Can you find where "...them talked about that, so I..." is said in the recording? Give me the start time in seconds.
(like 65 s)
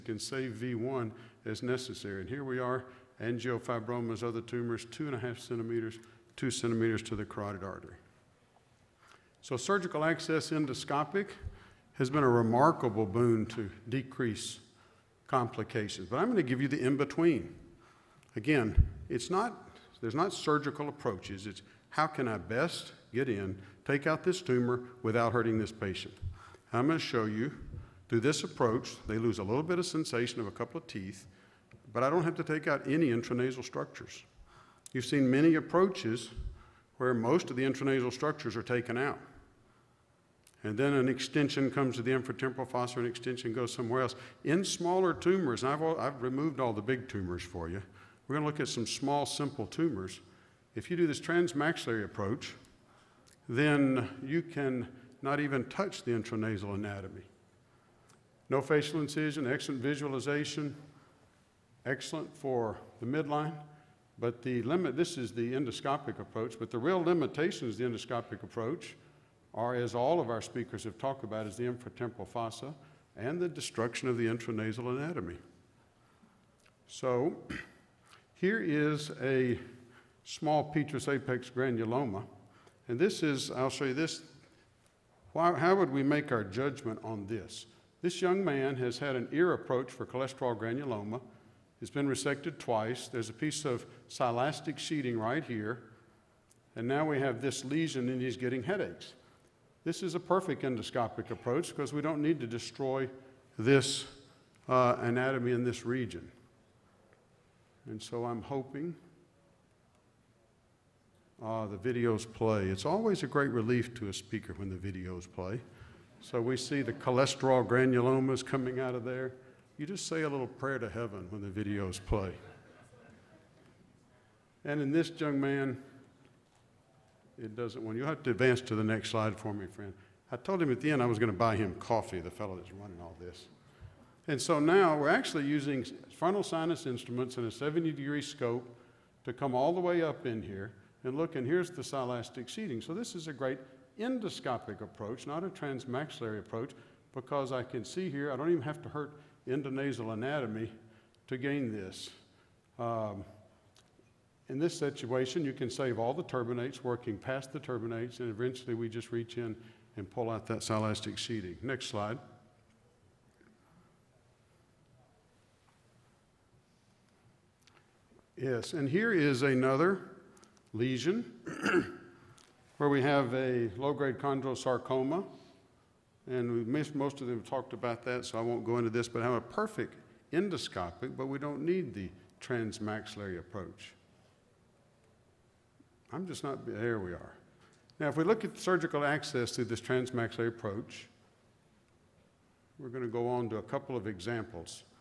177 s.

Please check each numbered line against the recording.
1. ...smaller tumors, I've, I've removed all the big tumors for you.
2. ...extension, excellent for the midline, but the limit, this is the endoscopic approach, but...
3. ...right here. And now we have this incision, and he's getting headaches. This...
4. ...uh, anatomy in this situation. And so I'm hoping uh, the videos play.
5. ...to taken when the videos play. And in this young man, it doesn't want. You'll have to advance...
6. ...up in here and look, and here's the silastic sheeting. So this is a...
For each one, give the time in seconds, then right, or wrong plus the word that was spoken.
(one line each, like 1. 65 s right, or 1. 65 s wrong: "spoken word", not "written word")
1. 44 s right
2. 59 s wrong: "visualization", not "extension"
3. 95 s wrong: "lesion", not "incision"
4. 104 s wrong: "region", not "situation"
5. 120 s wrong: "heaven", not "taken"
6. 140 s right.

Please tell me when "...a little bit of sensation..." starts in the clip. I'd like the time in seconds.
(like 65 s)
29 s.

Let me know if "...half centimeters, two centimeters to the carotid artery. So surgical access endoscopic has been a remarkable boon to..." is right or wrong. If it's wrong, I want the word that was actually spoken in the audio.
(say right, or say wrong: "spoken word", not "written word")
right.